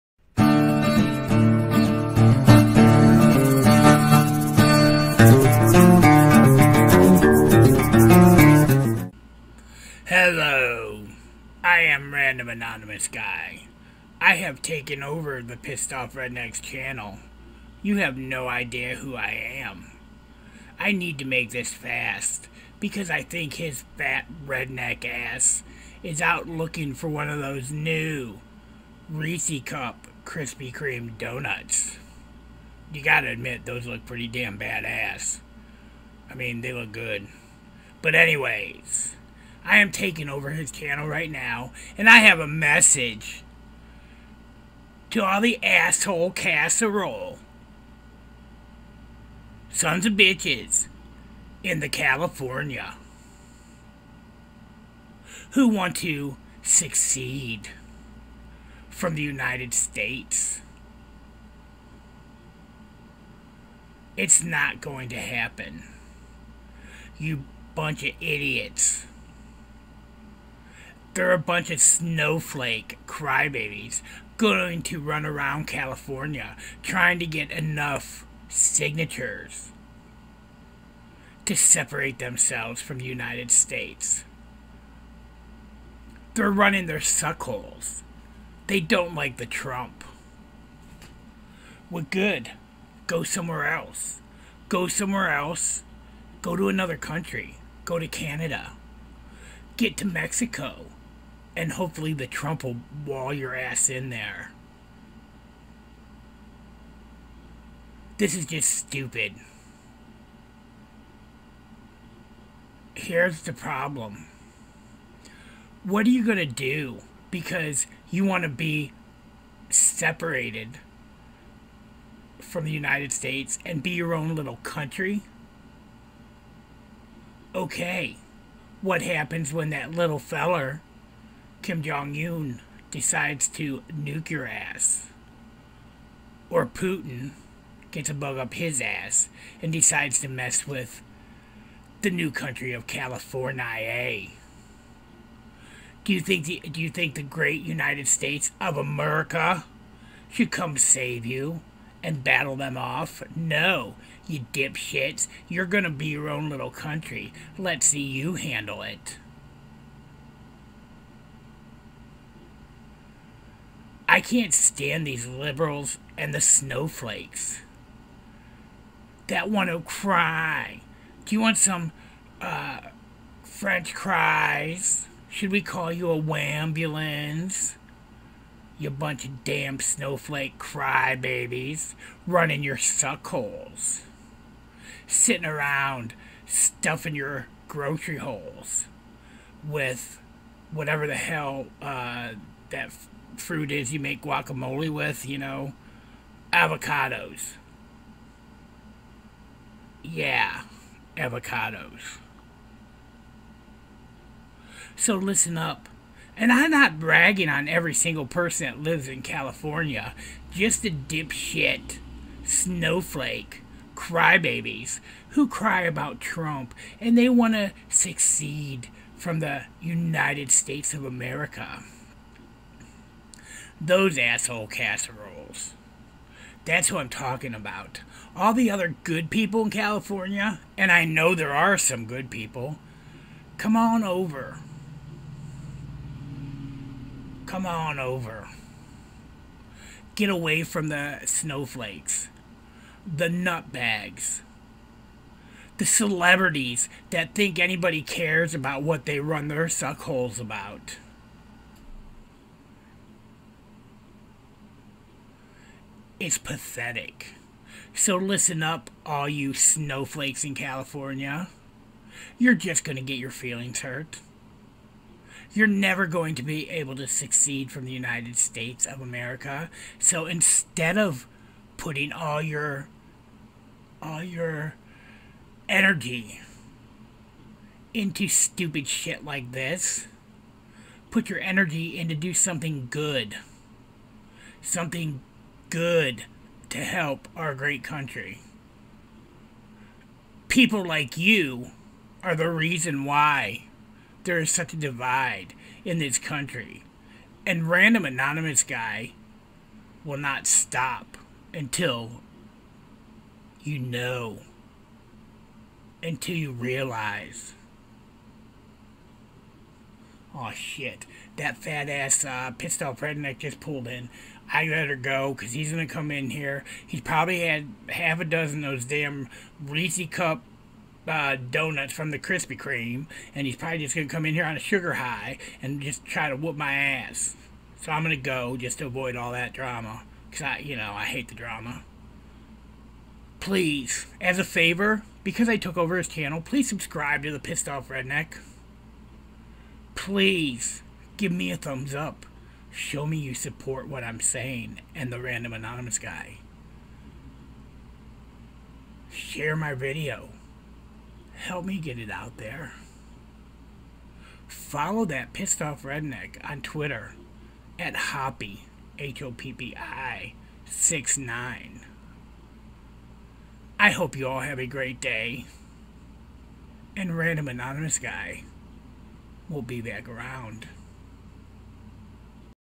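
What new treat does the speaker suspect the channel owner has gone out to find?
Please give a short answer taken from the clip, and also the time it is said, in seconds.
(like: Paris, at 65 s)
Reese Cup Krispy Kreme donuts, at 29 s.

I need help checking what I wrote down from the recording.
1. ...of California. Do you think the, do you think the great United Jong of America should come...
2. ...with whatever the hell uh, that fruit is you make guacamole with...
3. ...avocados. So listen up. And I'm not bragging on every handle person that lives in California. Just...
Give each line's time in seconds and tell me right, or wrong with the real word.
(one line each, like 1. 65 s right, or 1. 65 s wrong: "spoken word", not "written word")
1. 142 s wrong: "States", not "Jong"
2. 189 s right
3. 201 s wrong: "single", not "handle".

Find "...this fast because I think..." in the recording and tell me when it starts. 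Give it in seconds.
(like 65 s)
21 s.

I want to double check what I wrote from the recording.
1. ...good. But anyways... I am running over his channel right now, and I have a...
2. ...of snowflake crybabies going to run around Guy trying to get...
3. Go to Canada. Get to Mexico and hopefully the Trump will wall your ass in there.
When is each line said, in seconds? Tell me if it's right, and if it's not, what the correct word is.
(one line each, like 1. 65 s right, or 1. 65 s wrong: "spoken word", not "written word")
1. 36 s wrong: "taking", not "running"
2. 71 s wrong: "California", not "Guy"
3. 97 s right.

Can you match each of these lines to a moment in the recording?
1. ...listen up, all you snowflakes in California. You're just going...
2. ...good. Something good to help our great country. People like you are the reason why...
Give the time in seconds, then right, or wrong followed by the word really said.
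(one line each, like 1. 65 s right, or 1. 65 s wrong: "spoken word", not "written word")
1. 258 s right
2. 282 s right.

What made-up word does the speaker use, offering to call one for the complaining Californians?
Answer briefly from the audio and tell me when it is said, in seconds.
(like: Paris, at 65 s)
wambulance, at 176 s.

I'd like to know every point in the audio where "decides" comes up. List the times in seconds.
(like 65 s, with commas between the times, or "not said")
132 s, 139 s.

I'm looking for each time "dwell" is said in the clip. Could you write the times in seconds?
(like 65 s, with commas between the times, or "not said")
not said.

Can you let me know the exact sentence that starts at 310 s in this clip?
Oh shit, that fat ass uh, pissed redneck just pulled in.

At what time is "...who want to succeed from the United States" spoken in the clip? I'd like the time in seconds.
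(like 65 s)
55 s.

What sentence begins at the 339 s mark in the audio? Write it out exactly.
Please give me a thumbs up show me you support what I'm saying and the random anonymous guy.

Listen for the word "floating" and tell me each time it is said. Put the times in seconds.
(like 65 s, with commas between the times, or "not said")
not said.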